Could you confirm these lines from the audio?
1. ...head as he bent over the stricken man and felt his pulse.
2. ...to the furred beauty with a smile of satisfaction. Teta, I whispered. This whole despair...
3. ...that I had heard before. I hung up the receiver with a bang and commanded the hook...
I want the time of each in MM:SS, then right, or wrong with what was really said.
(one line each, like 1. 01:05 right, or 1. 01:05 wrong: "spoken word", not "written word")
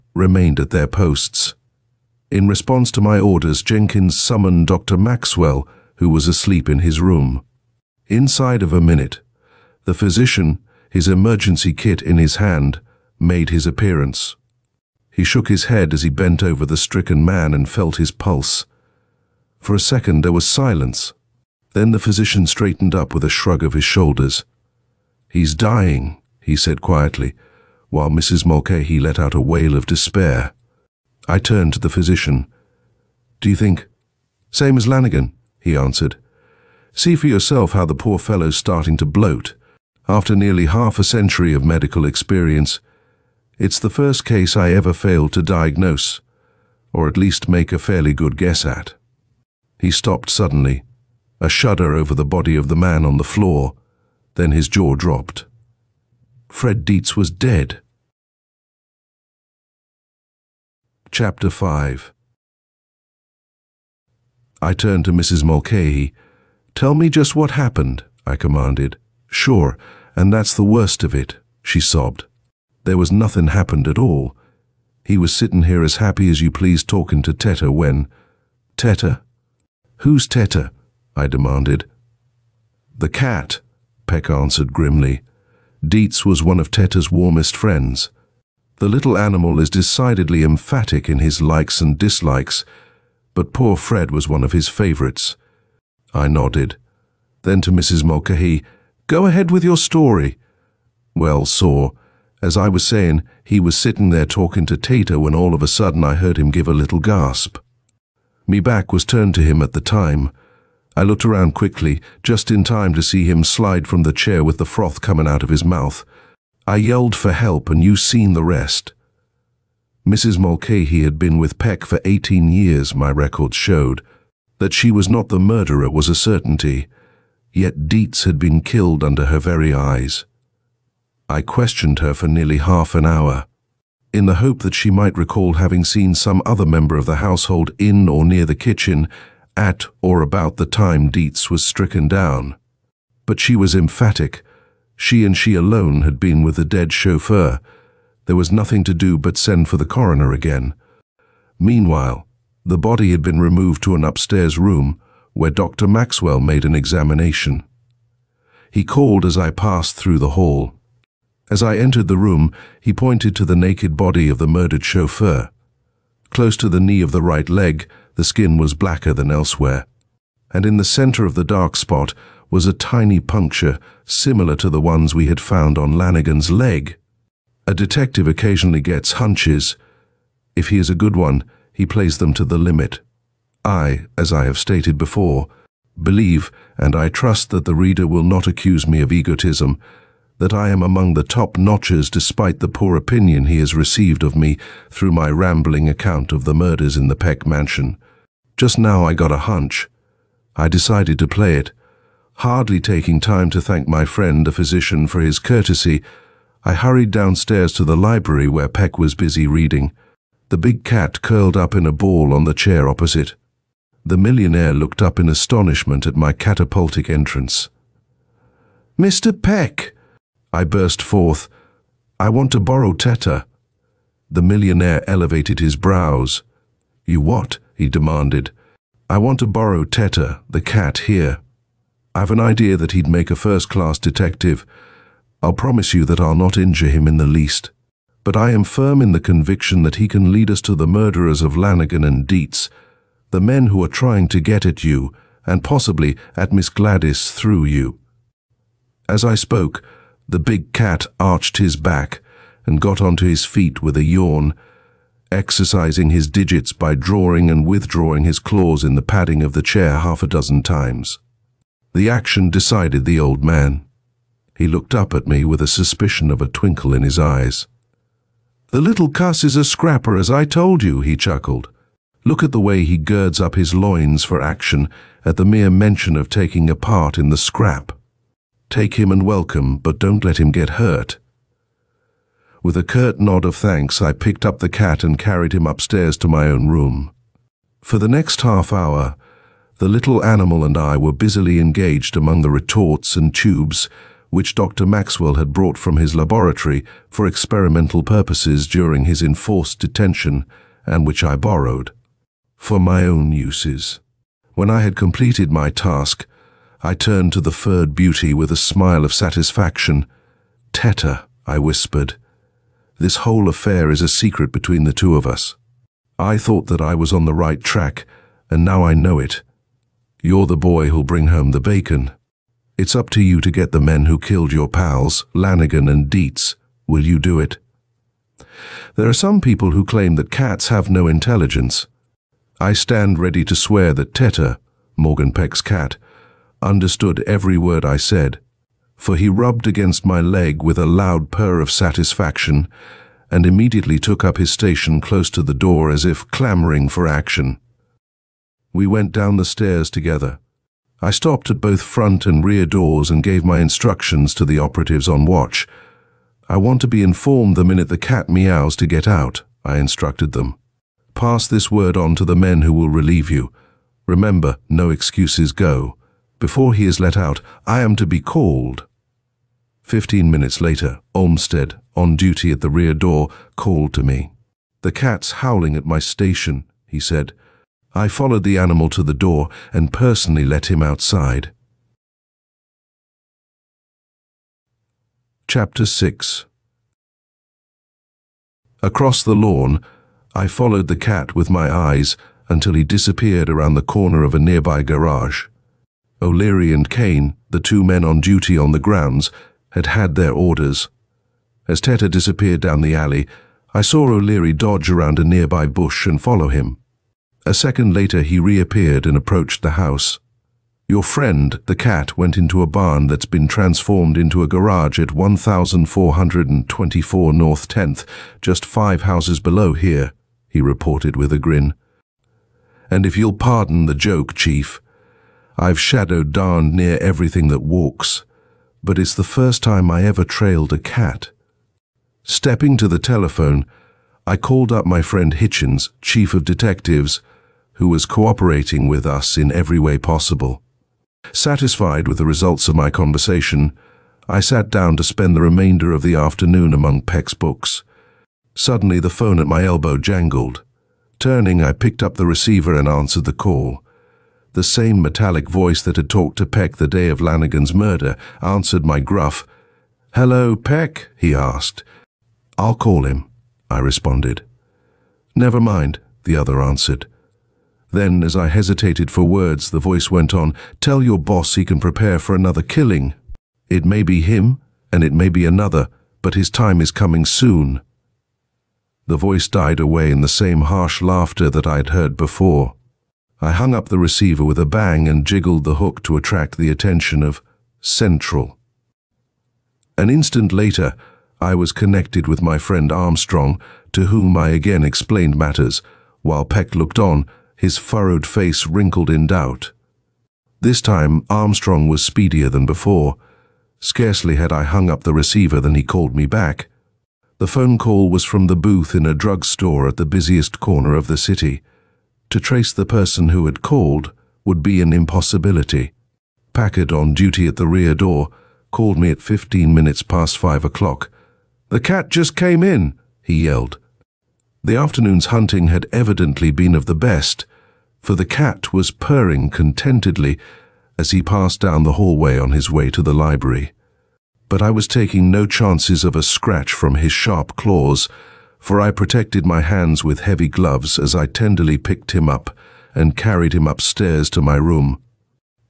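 1. 00:15 right
2. 05:07 wrong: "affair", not "despair"
3. 08:01 wrong: "jiggled", not "commanded".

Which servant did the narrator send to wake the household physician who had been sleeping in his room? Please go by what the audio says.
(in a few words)
Jenkins.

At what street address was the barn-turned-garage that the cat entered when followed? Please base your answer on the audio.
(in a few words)
1424 North 10th.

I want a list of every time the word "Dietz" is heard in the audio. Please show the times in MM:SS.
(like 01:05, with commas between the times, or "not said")
00:56, 01:25, 02:07, 02:21, 04:02, 05:26.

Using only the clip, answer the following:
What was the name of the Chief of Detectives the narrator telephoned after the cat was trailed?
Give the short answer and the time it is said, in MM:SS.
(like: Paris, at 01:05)
Hitchens, at 07:15.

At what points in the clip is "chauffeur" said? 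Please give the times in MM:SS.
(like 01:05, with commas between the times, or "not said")
02:26, 02:44.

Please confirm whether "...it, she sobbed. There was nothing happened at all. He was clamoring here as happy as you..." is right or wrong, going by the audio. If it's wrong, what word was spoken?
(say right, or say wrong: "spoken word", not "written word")
wrong: "sitting", not "clamoring".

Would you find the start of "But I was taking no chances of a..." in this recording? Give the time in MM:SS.
08:54.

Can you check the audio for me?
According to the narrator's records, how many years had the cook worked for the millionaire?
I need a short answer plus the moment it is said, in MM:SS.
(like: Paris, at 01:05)
18, at 02:02.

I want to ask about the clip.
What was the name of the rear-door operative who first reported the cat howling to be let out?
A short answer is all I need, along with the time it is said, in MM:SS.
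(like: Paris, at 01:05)
Olmsted, at 06:11.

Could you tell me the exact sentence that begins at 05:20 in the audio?
You're the boy who'll bring home the bacon.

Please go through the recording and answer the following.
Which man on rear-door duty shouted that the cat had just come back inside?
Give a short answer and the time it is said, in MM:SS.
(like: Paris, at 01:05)
Packard, at 08:36.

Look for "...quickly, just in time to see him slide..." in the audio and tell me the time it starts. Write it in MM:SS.
01:51.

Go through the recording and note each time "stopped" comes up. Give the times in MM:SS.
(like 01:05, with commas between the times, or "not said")
00:49, 05:51.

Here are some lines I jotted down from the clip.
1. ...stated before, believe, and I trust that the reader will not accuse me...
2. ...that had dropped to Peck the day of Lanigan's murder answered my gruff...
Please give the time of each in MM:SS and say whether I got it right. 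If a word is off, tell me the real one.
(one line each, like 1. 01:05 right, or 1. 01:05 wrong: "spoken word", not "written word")
1. 03:04 right
2. 07:35 wrong: "talked", not "dropped".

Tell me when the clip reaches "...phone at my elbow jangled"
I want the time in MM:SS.
07:29.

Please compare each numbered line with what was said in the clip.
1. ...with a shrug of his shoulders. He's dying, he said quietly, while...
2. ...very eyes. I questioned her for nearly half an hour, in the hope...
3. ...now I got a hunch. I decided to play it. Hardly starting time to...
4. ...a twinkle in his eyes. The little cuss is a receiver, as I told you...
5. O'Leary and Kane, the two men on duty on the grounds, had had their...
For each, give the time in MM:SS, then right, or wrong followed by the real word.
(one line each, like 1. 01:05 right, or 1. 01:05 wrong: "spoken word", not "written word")
1. 00:23 right
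2. 02:09 right
3. 03:18 wrong: "taking", not "starting"
4. 04:26 wrong: "scrapper", not "receiver"
5. 06:36 right.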